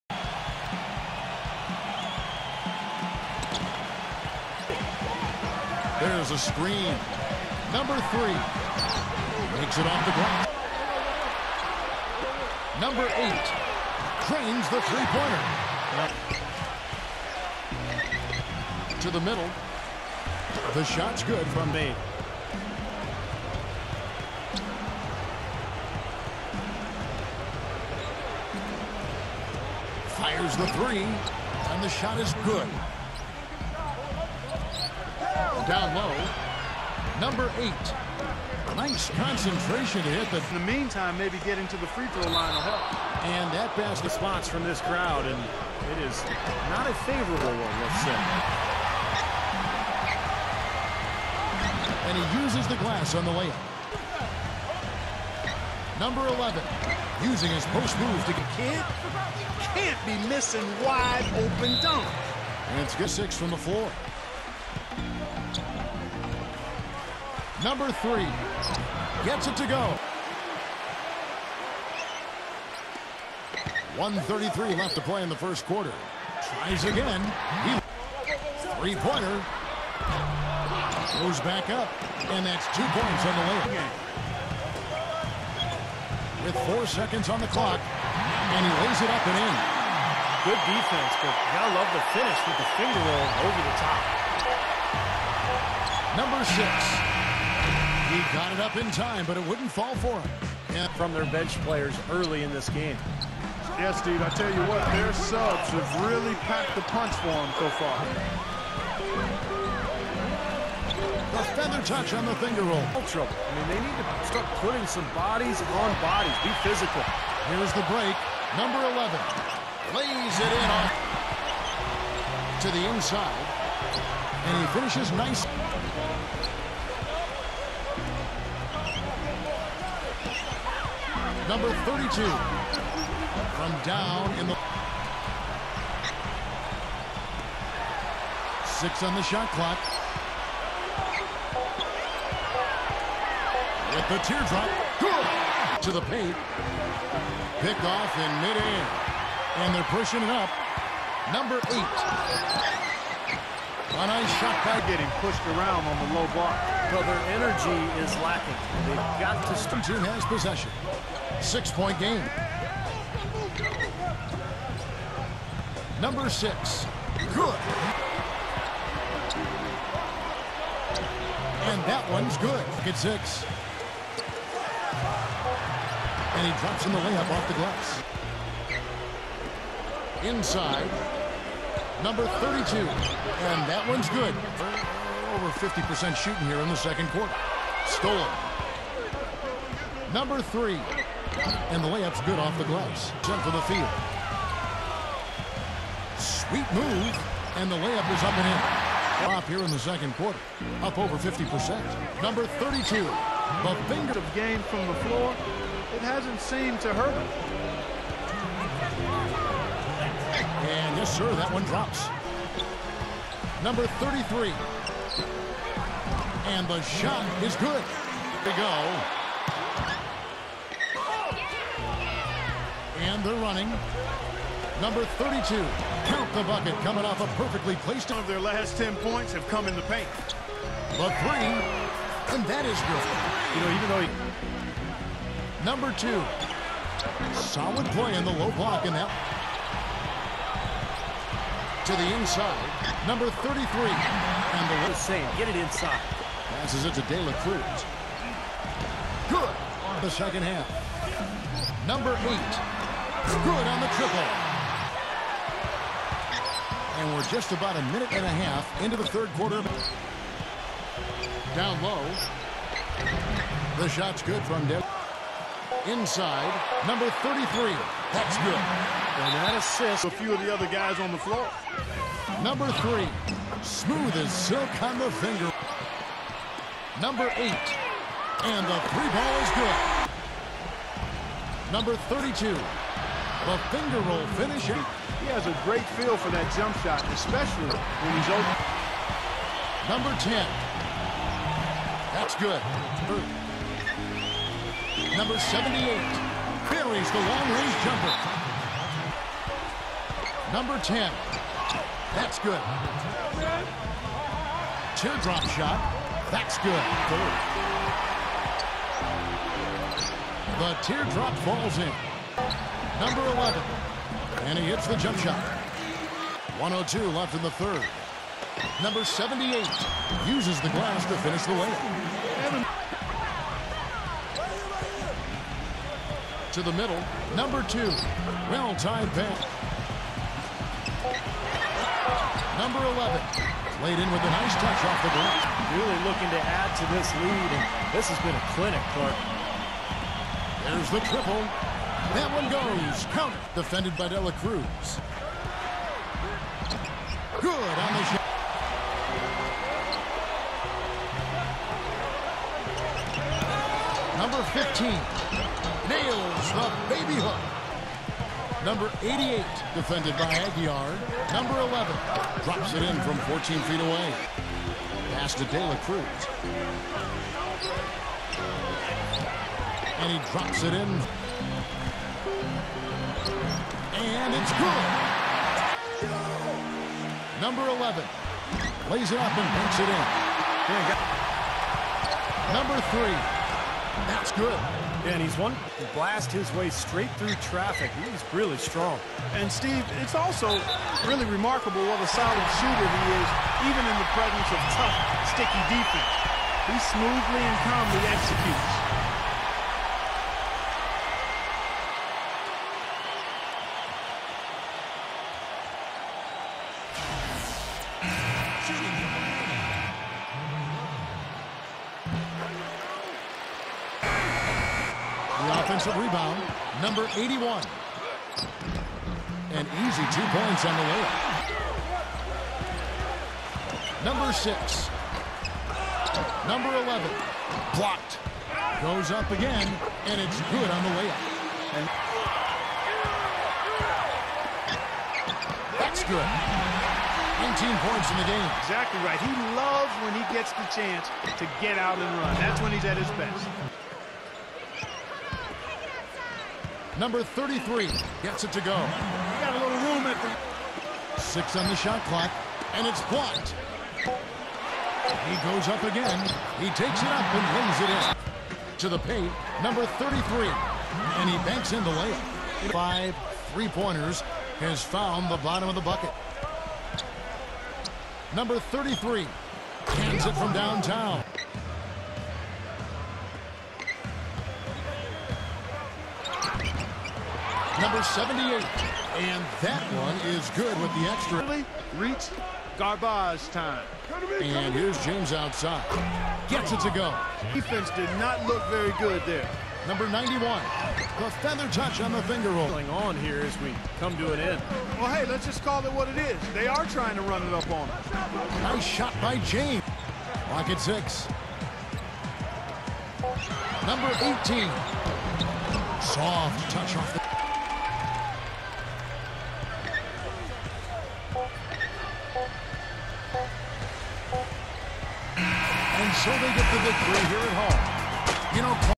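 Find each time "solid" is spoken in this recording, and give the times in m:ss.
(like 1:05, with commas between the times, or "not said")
3:57, 6:32.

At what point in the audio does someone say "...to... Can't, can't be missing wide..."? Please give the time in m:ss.
0:58.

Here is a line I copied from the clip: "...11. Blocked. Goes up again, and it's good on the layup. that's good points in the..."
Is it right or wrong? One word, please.
right.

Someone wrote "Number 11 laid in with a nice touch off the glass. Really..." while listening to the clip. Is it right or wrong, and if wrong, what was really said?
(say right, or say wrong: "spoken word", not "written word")
right.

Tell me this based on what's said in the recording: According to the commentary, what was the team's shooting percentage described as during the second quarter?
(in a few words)
Over 50%.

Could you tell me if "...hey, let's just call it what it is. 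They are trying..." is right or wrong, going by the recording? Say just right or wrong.
right.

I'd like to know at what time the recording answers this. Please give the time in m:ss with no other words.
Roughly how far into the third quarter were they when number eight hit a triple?
4:17.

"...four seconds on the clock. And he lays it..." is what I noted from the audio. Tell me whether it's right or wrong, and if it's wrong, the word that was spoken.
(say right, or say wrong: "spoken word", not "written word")
right.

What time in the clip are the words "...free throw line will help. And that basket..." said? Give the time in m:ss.
0:41.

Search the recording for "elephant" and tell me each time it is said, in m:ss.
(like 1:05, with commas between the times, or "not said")
not said.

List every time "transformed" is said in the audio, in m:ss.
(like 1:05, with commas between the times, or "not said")
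not said.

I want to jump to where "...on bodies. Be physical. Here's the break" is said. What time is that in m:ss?
1:55.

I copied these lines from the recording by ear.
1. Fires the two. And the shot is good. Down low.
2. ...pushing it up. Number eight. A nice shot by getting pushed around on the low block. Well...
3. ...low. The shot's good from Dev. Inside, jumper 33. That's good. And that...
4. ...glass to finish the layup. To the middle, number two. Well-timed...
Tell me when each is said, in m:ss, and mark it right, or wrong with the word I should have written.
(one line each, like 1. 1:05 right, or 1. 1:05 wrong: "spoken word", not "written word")
1. 0:30 wrong: "three", not "two"
2. 2:29 right
3. 4:21 wrong: "number", not "jumper"
4. 5:20 right.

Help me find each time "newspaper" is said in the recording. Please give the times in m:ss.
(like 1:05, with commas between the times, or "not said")
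not said.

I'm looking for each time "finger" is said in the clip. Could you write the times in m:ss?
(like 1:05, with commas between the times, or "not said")
1:32, 1:52, 3:23, 4:35, 4:43, 8:12.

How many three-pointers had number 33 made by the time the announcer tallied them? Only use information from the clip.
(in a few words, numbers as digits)
5.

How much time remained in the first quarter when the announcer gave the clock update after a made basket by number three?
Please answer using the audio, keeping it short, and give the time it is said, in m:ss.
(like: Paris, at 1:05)
1:33, at 1:13.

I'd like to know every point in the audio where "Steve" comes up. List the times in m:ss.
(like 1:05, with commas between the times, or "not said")
1:44, 6:29.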